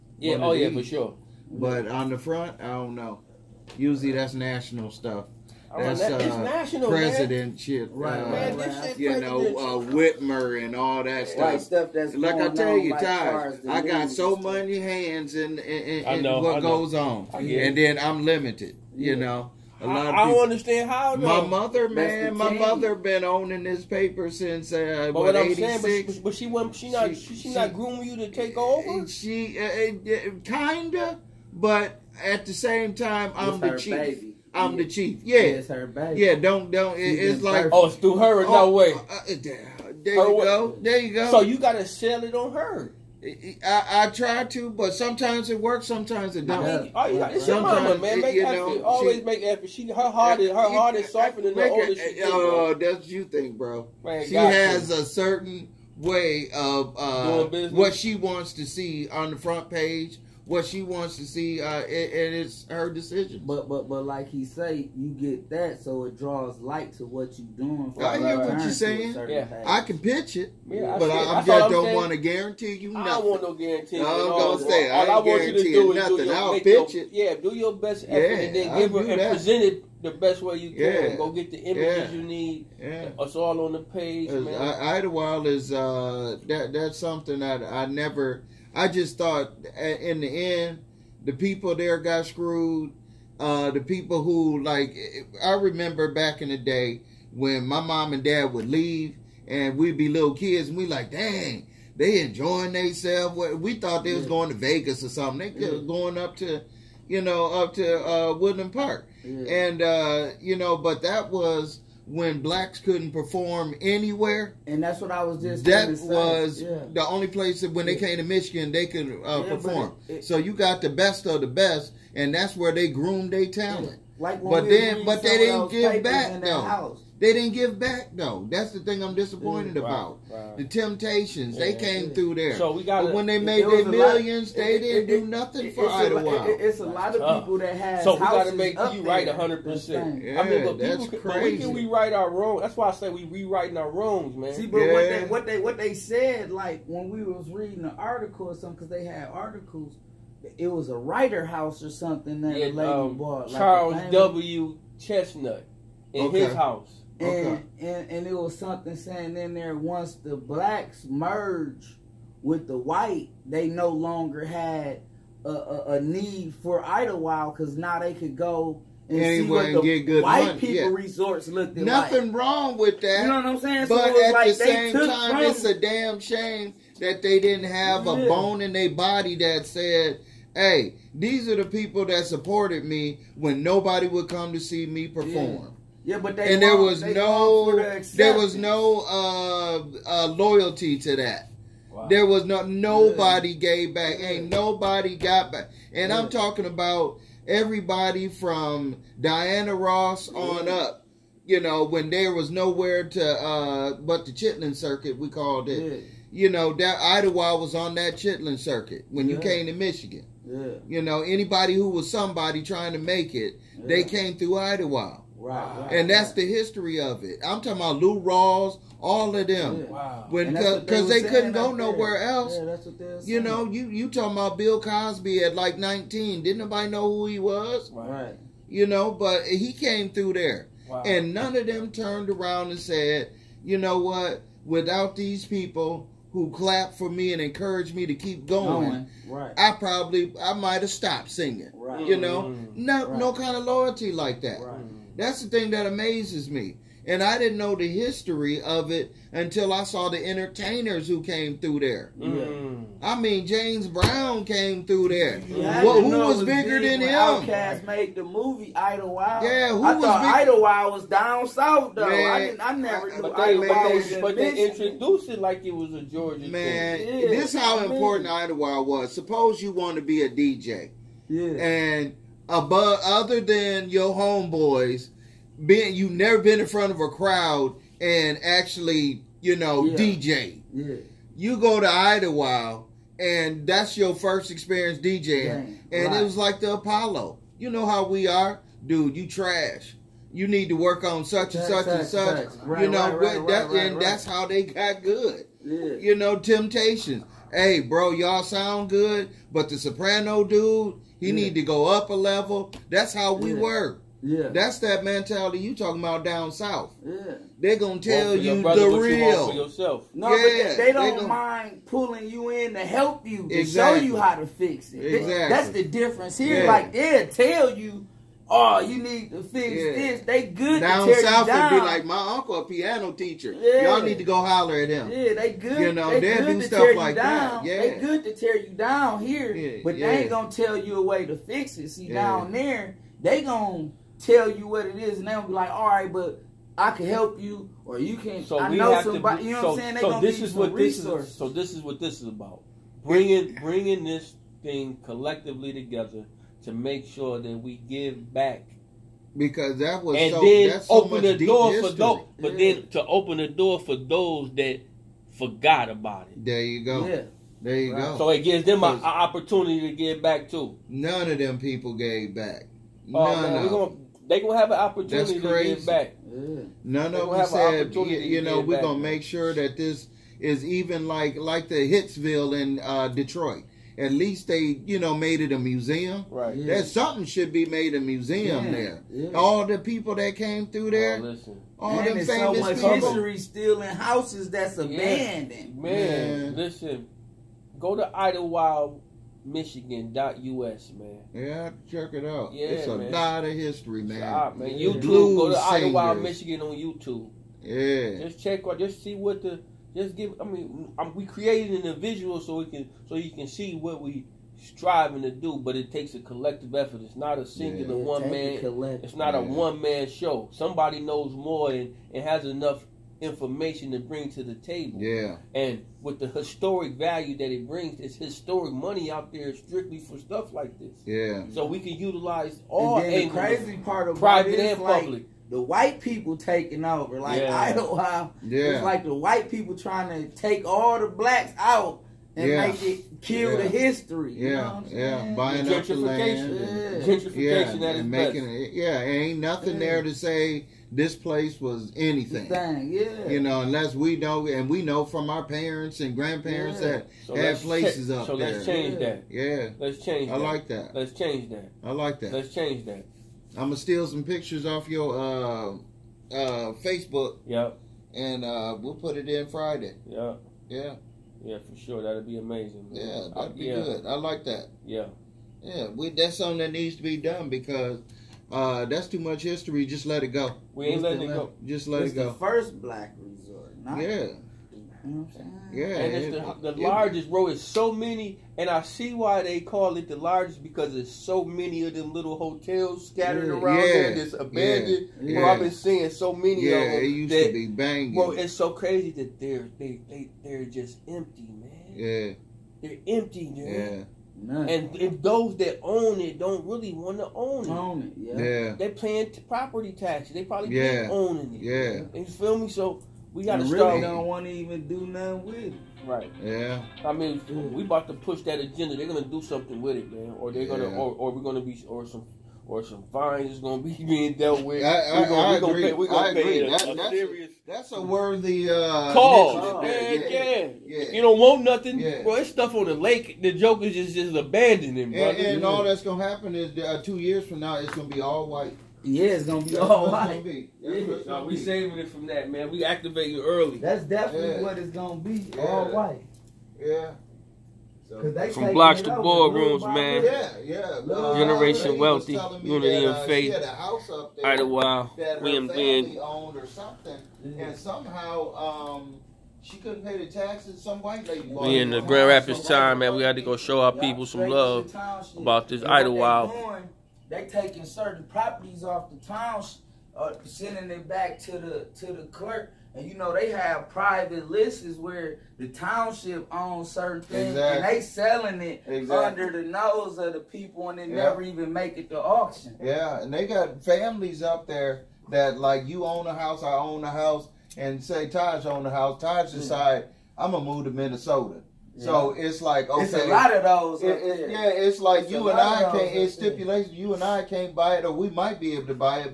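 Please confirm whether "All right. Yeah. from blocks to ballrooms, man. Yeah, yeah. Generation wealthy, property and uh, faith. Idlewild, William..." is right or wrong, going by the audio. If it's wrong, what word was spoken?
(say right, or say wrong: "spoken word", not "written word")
wrong: "unity", not "property".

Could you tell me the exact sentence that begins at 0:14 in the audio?
many hands in, in, in, in know, what goes on, and then I'm limited.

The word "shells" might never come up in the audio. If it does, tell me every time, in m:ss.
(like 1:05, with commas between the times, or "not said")
not said.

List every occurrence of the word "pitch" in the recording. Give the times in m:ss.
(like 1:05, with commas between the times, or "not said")
1:09, 1:16.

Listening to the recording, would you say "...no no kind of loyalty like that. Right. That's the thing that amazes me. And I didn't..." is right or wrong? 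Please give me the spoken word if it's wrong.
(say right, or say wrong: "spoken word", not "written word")
right.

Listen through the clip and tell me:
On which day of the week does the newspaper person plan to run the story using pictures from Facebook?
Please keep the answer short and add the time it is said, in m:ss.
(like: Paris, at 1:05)
Friday, at 7:39.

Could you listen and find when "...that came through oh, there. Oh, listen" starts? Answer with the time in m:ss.
6:20.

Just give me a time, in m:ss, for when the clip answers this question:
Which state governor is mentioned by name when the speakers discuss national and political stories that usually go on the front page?
0:09.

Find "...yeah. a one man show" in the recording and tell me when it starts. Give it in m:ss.
6:49.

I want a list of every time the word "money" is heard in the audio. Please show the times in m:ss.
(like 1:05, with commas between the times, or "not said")
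2:50, 6:58.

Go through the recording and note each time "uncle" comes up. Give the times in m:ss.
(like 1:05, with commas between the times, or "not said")
5:22.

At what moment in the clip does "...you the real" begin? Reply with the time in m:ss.
5:08.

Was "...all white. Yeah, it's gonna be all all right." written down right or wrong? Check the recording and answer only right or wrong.
right.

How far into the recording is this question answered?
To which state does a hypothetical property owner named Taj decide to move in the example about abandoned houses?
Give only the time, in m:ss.
9:40.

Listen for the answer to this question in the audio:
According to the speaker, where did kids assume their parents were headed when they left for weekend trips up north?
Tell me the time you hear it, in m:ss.
1:44.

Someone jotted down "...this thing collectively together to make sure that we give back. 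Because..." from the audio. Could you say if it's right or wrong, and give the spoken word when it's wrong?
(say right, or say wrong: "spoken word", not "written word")
right.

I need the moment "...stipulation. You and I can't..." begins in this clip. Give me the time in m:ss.
9:46.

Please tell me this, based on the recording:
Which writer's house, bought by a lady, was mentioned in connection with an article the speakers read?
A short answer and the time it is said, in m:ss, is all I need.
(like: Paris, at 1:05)
Charles W. Chesnutt, at 2:33.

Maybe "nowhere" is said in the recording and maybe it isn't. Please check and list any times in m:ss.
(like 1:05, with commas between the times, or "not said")
3:22, 3:41.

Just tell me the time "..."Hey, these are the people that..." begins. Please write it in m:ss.
3:00.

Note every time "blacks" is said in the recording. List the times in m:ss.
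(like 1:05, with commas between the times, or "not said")
1:52, 2:40, 7:11, 7:52.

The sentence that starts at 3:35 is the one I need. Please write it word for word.
Right, and that's the history of it.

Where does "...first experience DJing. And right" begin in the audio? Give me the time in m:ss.
4:44.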